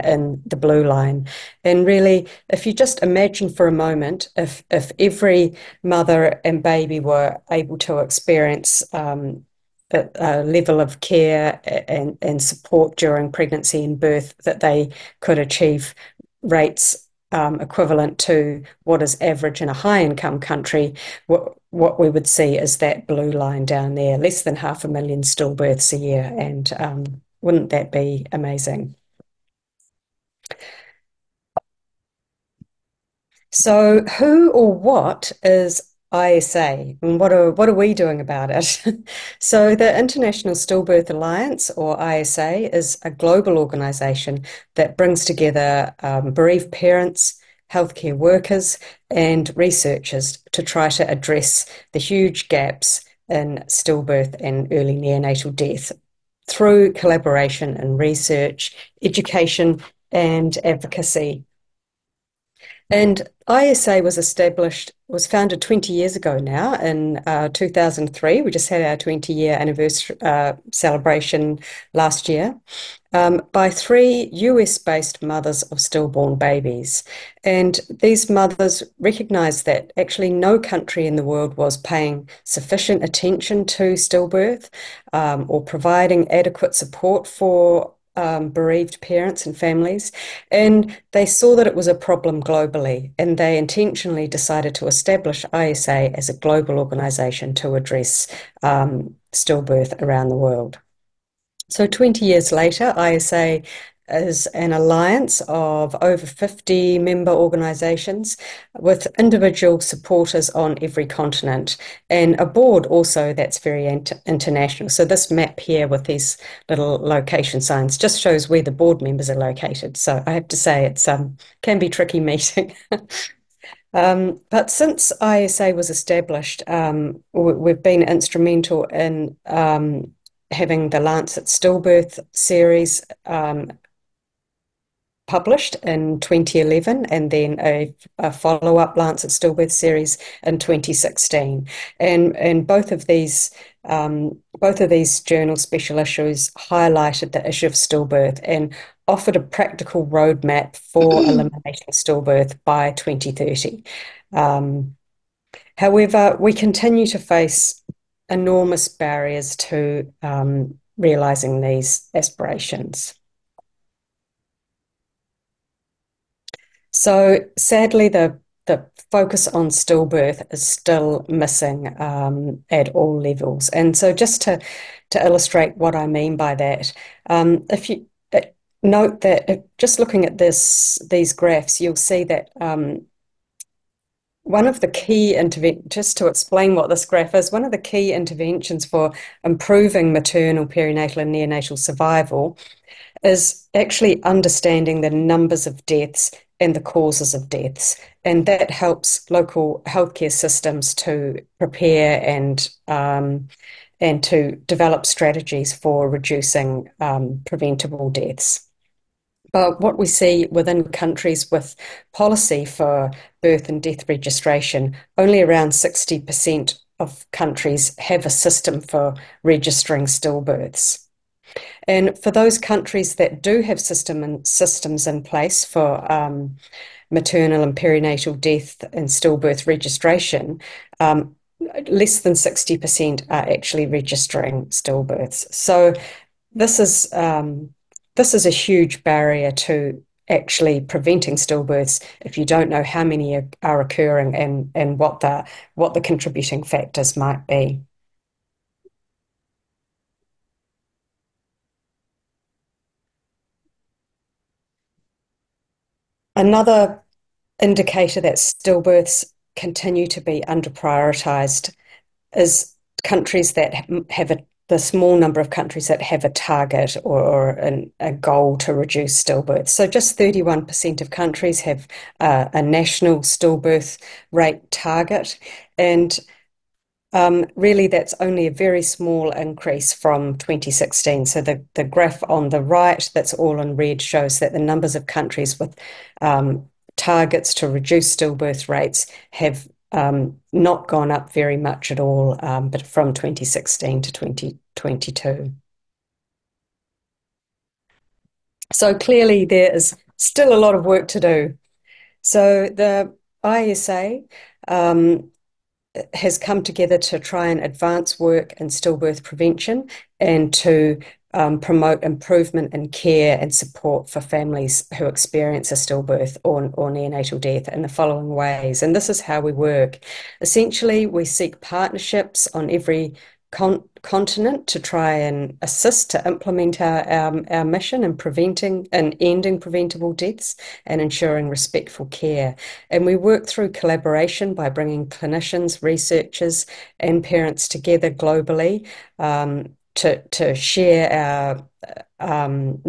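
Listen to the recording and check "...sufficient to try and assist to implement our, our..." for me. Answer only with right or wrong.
wrong.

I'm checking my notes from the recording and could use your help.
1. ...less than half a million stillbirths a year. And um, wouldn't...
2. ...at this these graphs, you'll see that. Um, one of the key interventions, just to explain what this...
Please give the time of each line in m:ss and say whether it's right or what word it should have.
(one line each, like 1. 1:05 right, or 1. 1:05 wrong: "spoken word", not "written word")
1. 0:24 right
2. 3:00 right.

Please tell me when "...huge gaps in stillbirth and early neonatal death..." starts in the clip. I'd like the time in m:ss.
0:51.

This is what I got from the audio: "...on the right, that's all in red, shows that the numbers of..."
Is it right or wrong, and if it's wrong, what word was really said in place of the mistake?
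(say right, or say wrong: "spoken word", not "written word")
right.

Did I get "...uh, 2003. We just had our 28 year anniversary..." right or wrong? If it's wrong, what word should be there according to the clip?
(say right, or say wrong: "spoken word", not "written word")
wrong: "20", not "28".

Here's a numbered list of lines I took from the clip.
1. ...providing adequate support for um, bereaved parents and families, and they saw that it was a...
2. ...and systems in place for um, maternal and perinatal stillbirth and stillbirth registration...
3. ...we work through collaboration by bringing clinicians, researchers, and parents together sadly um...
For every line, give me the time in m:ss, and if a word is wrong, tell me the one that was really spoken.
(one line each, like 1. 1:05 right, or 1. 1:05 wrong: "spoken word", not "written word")
1. 1:25 right
2. 3:44 wrong: "death", not "stillbirth"
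3. 5:33 wrong: "globally", not "sadly".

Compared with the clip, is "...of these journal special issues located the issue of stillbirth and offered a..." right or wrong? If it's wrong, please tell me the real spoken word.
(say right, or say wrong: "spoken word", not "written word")
wrong: "highlighted", not "located".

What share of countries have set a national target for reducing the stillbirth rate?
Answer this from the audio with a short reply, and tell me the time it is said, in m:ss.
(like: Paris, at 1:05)
31%, at 4:30.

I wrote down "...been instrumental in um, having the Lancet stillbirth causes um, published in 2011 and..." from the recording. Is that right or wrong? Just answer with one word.
wrong.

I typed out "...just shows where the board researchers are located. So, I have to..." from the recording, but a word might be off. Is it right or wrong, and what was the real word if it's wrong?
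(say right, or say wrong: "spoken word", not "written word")
wrong: "members", not "researchers".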